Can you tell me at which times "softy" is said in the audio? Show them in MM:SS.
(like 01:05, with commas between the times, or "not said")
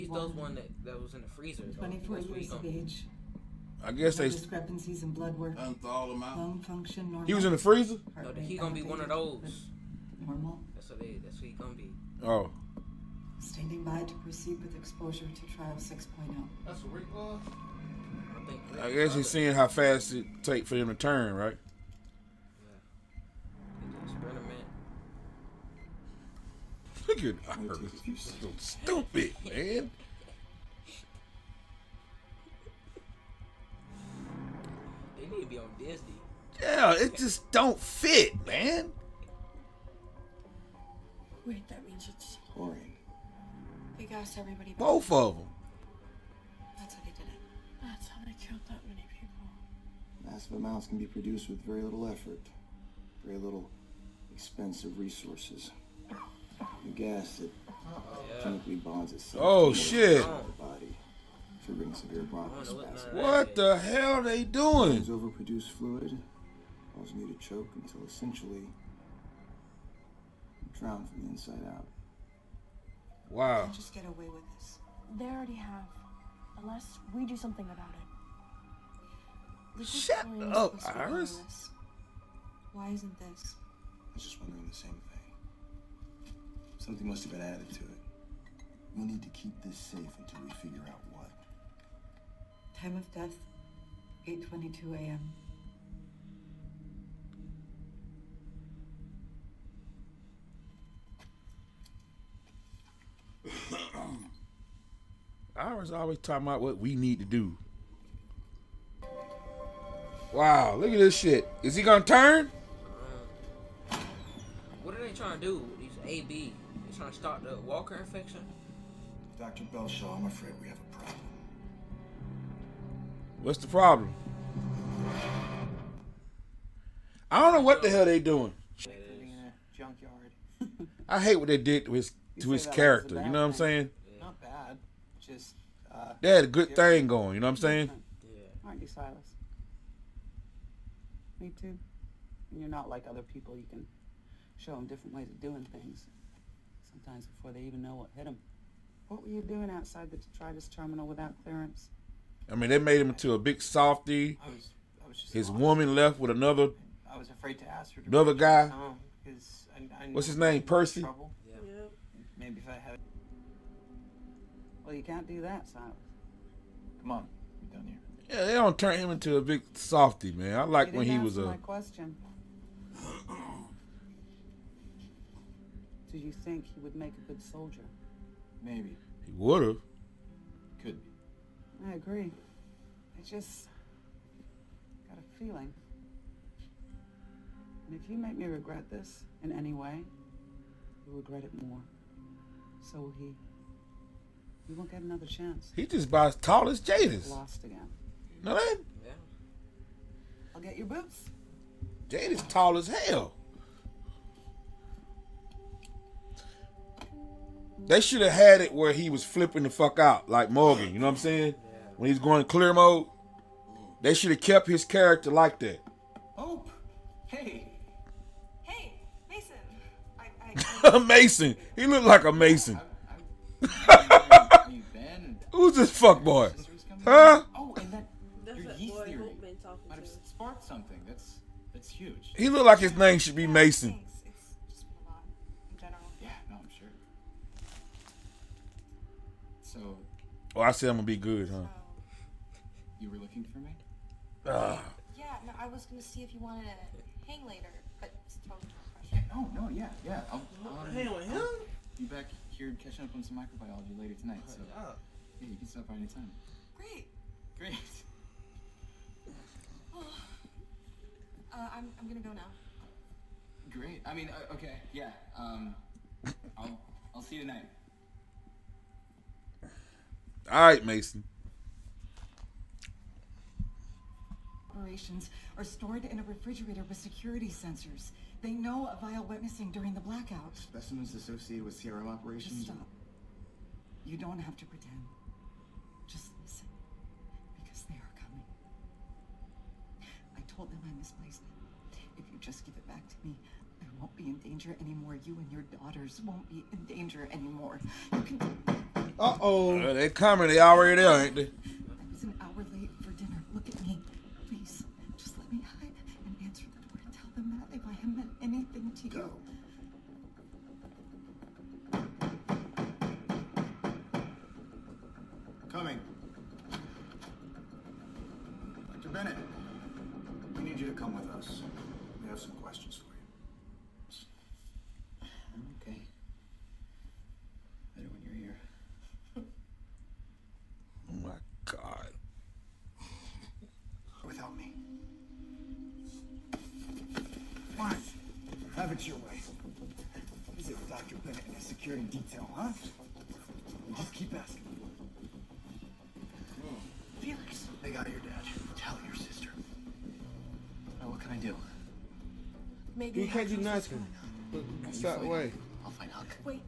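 02:33, 02:49.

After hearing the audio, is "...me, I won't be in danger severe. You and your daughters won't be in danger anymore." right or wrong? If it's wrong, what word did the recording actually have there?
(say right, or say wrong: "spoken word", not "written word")
wrong: "anymore", not "severe".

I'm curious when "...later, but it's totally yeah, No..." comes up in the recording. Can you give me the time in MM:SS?
04:07.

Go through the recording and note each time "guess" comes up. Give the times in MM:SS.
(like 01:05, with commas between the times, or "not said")
00:03, 00:18.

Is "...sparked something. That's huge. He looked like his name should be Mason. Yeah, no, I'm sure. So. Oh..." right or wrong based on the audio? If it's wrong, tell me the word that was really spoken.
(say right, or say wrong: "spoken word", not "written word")
right.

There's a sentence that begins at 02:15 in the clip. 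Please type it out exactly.
Just uh, they had a good thing going.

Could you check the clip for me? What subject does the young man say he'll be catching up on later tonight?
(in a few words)
microbiology.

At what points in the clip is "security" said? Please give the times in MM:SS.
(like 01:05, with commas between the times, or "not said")
04:36, 05:41.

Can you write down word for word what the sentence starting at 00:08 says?
No, he gonna be one of those.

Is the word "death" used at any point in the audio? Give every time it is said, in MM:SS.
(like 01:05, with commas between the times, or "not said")
01:33.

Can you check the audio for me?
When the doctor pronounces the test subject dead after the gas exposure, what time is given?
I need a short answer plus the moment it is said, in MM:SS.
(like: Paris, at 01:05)
8:22 a.m., at 01:34.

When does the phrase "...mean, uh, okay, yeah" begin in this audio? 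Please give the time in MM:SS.
04:24.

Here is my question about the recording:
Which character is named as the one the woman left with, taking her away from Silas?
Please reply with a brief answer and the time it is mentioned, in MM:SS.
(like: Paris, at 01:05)
Percy, at 02:40.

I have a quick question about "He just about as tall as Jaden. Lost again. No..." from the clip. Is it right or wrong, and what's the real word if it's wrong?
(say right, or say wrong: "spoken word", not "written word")
right.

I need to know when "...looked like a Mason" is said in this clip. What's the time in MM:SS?
03:41.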